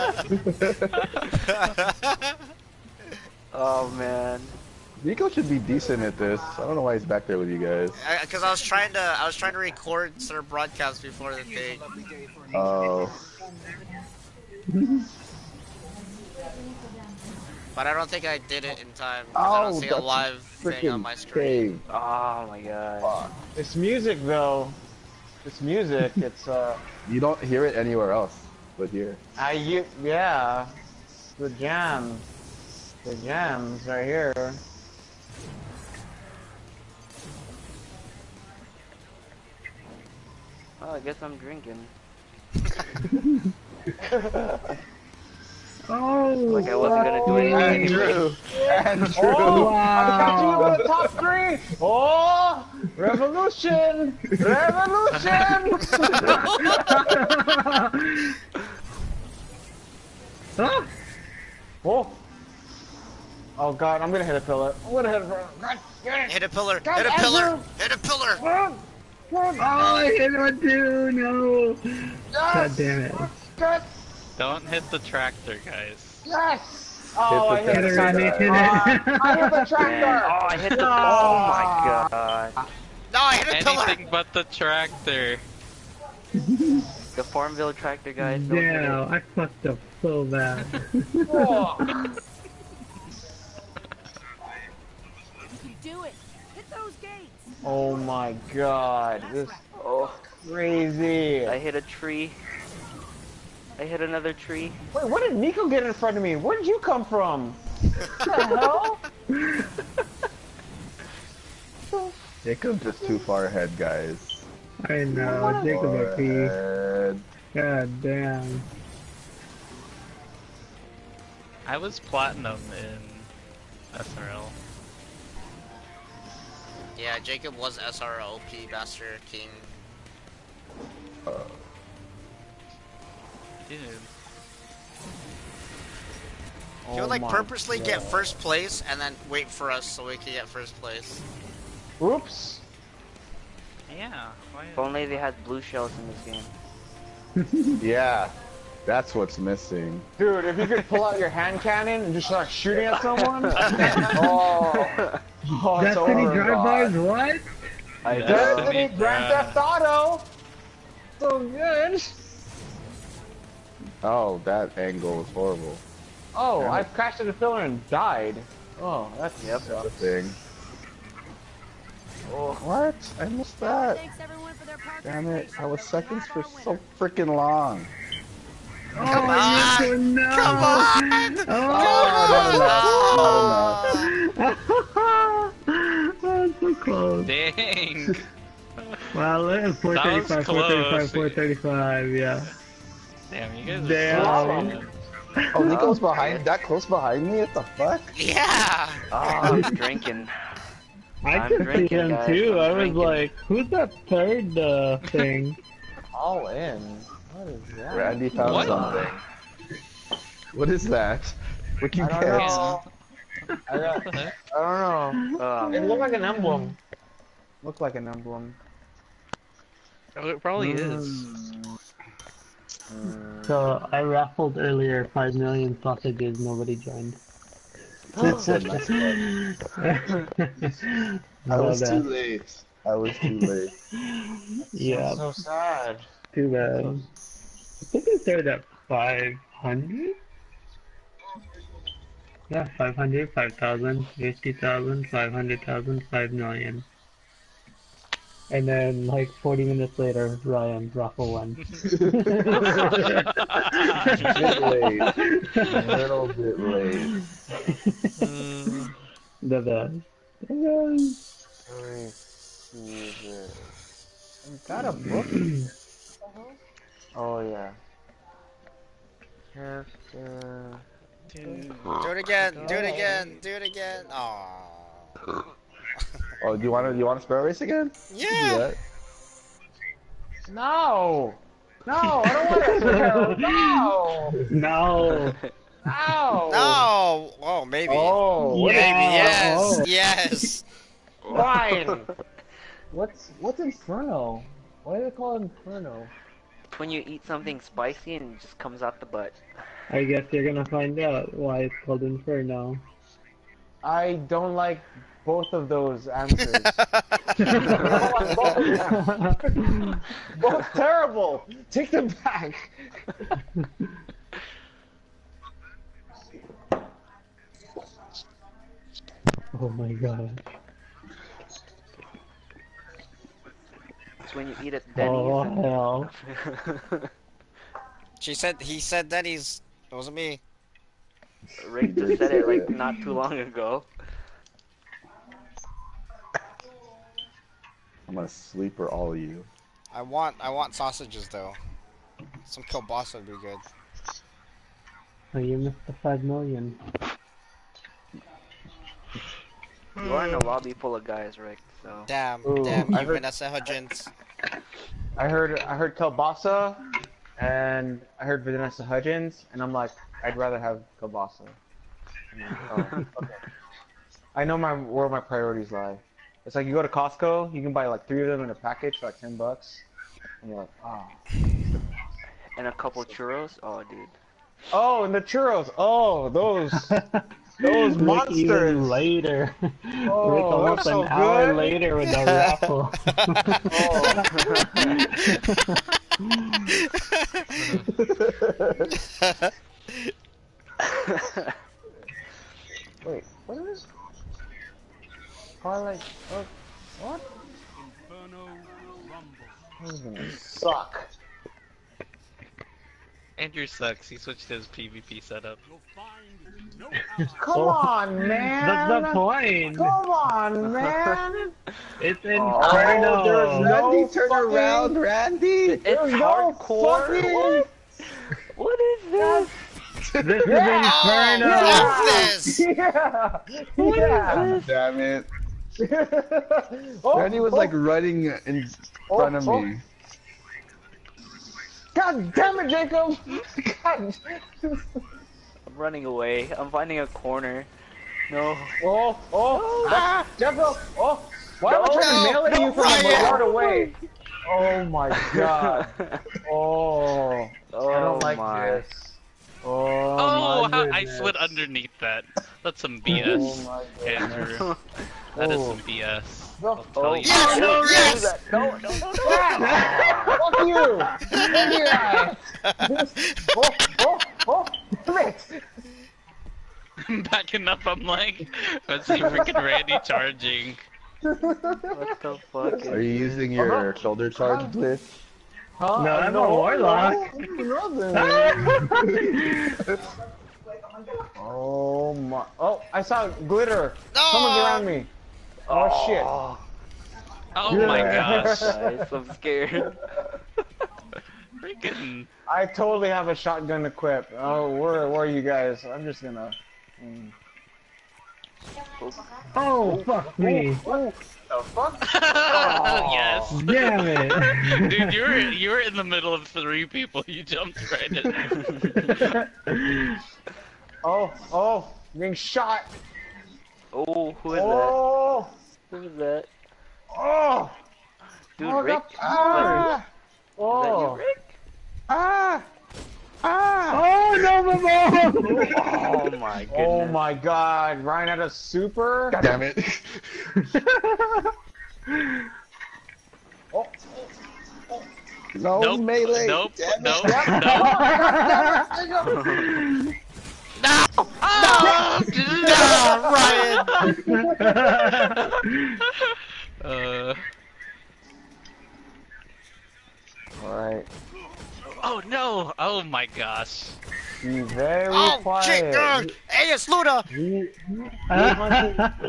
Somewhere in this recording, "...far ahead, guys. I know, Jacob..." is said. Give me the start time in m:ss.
1:53.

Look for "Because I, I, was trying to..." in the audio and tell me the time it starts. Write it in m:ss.
0:08.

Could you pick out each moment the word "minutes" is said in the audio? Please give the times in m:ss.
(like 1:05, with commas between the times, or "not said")
4:09.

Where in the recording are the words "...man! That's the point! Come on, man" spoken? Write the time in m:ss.
6:48.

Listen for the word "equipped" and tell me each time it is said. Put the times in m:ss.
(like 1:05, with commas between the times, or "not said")
8:13.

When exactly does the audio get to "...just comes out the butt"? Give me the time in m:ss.
4:58.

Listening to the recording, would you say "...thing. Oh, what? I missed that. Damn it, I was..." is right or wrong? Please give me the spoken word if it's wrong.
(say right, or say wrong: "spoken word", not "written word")
right.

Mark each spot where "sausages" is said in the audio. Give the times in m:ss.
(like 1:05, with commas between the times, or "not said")
3:45, 5:40.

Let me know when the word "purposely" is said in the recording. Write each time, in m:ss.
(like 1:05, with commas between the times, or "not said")
2:17.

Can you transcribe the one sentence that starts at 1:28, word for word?
Yeah, I fucked up so bad.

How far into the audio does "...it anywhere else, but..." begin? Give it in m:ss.
0:27.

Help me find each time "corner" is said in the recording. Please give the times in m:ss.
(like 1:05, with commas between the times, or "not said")
7:17.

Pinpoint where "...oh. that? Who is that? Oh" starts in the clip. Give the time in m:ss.
8:34.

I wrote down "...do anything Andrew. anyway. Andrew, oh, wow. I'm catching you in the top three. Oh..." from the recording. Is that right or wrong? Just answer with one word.
right.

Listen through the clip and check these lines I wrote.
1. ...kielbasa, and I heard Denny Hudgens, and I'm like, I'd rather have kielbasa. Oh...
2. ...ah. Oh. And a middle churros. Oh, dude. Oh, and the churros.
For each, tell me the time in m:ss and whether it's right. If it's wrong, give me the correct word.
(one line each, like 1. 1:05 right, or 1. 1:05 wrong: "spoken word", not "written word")
1. 5:55 wrong: "Vanessa", not "Denny"
2. 6:10 wrong: "couple", not "middle".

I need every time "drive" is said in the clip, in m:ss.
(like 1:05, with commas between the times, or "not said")
2:36.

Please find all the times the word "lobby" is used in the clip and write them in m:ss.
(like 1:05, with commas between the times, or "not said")
5:50.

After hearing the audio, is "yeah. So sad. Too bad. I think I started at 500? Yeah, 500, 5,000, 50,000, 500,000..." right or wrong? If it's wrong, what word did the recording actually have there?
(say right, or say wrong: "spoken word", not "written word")
right.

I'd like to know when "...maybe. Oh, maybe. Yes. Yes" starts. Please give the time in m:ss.
4:47.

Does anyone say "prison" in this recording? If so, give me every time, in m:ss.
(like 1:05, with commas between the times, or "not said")
not said.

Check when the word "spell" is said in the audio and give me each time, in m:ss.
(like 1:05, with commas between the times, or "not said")
4:37, 4:42.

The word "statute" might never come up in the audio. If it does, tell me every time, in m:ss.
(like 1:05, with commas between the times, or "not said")
not said.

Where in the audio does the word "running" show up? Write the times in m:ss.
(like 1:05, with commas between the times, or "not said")
7:07, 7:15.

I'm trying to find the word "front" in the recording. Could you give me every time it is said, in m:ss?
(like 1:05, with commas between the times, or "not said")
1:45, 7:09.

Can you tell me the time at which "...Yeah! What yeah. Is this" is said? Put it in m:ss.
7:02.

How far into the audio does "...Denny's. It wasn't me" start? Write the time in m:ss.
5:29.